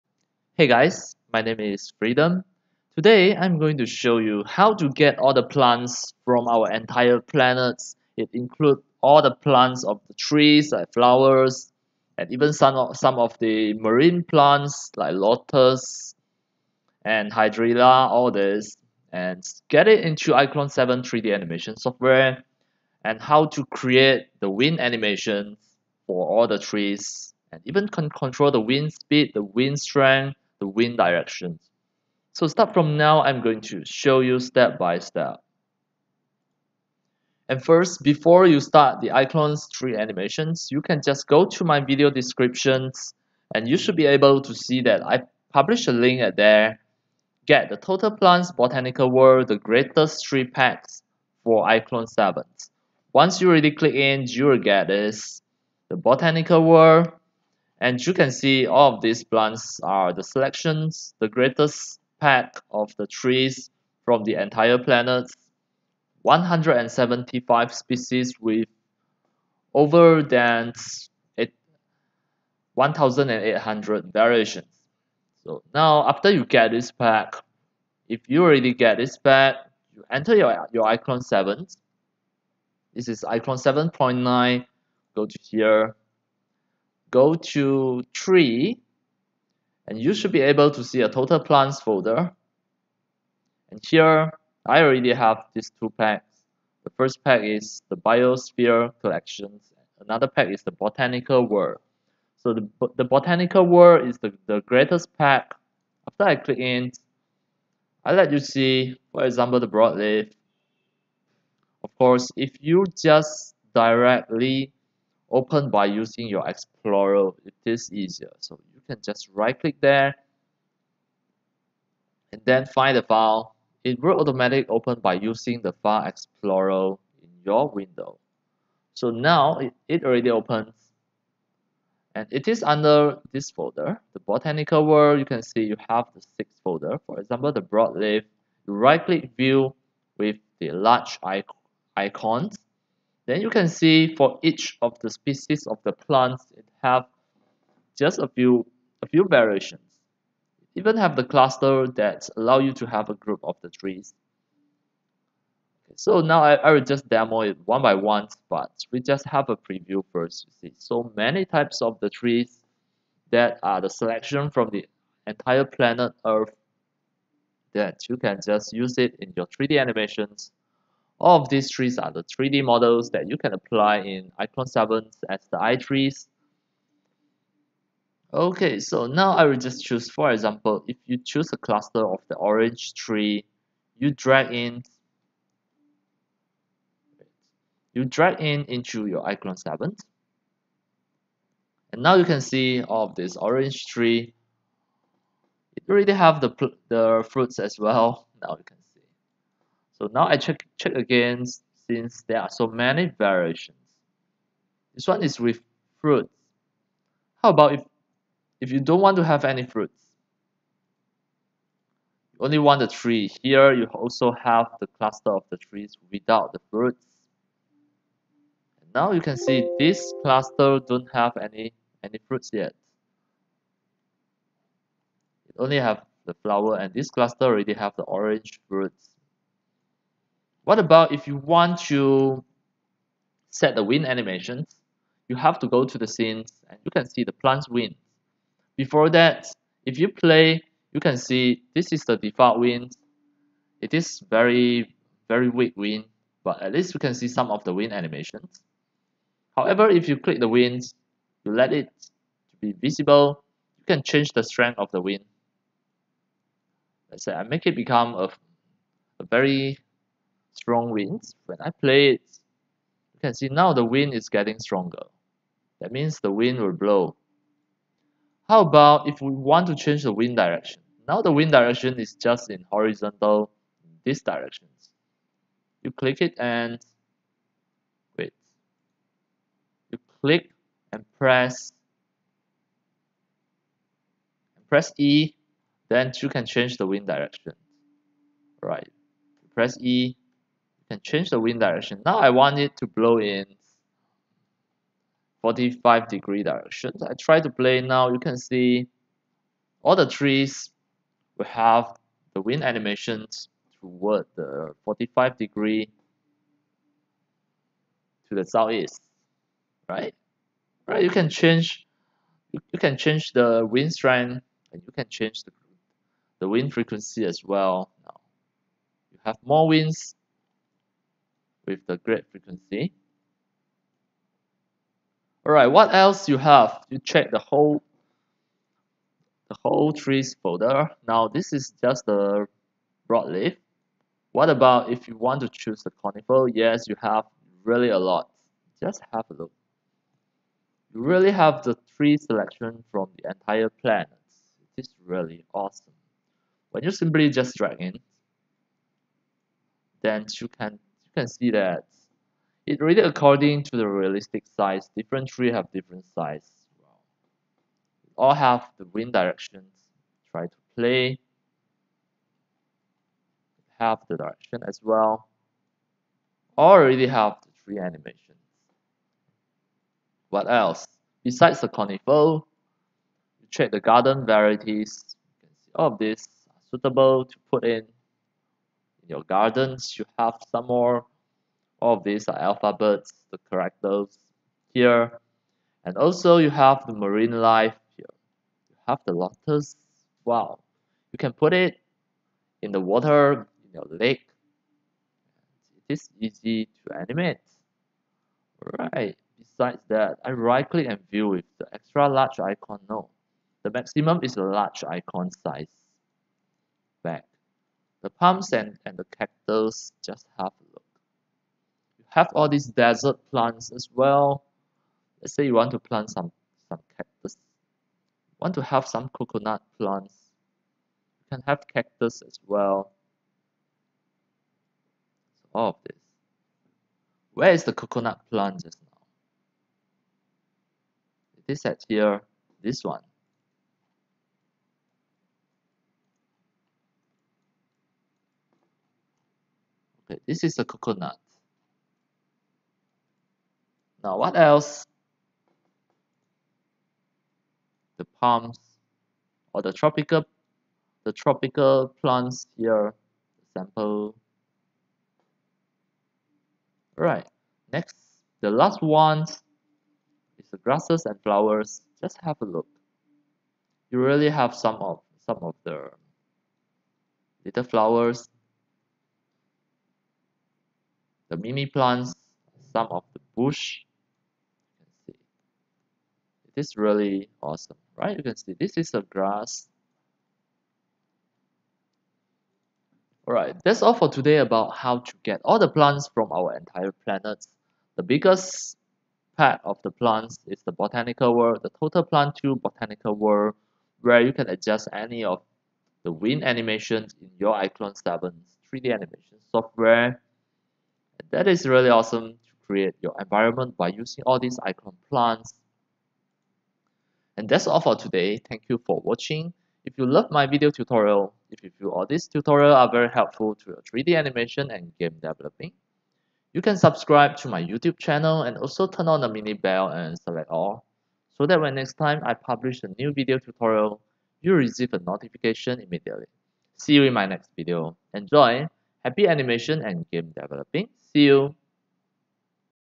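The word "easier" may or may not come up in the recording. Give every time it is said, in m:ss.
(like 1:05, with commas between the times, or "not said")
1:57.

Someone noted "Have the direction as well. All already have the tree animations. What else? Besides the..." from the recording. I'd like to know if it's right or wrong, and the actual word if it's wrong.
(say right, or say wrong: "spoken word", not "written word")
right.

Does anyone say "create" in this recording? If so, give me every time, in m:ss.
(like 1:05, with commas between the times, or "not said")
0:23, 8:22.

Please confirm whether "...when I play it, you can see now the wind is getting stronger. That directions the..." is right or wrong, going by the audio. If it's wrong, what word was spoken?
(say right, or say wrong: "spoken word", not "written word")
wrong: "means", not "directions".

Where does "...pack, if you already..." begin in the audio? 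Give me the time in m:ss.
1:16.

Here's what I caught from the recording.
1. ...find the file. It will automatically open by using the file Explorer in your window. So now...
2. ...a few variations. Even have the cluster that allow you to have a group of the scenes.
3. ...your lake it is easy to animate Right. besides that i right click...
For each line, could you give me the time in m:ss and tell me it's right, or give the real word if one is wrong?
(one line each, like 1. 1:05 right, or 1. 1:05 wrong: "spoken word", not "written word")
1. 2:02 right
2. 2:29 wrong: "trees", not "scenes"
3. 6:33 right.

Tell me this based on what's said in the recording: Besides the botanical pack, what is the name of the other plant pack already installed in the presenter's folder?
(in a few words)
Biosphere Collections.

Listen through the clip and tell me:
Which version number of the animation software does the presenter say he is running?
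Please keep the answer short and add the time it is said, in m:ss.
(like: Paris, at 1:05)
7.9, at 1:23.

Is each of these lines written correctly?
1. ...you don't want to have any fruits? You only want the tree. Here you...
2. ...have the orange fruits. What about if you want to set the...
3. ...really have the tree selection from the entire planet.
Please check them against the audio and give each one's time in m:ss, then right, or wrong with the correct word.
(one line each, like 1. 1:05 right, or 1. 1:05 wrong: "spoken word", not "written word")
1. 3:28 right
2. 3:47 right
3. 5:41 right.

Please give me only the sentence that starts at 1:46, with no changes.
After I click in, I let you see, for example, the broadleaf.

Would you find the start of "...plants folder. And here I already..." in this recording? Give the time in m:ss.
1:31.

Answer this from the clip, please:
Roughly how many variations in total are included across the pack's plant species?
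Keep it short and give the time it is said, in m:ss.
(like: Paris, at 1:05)
over 1,800, at 1:09.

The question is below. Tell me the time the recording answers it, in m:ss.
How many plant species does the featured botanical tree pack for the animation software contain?
1:06.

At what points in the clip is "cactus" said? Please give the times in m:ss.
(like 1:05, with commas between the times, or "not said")
6:49, 6:56, 7:01.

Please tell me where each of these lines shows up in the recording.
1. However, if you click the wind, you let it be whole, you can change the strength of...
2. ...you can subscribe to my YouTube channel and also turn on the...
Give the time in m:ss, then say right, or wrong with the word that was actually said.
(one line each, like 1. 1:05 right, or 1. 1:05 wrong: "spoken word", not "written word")
1. 4:09 wrong: "visible", not "whole"
2. 8:36 right.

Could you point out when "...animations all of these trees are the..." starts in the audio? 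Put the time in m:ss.
2:49.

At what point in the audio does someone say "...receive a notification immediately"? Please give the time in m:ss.
8:44.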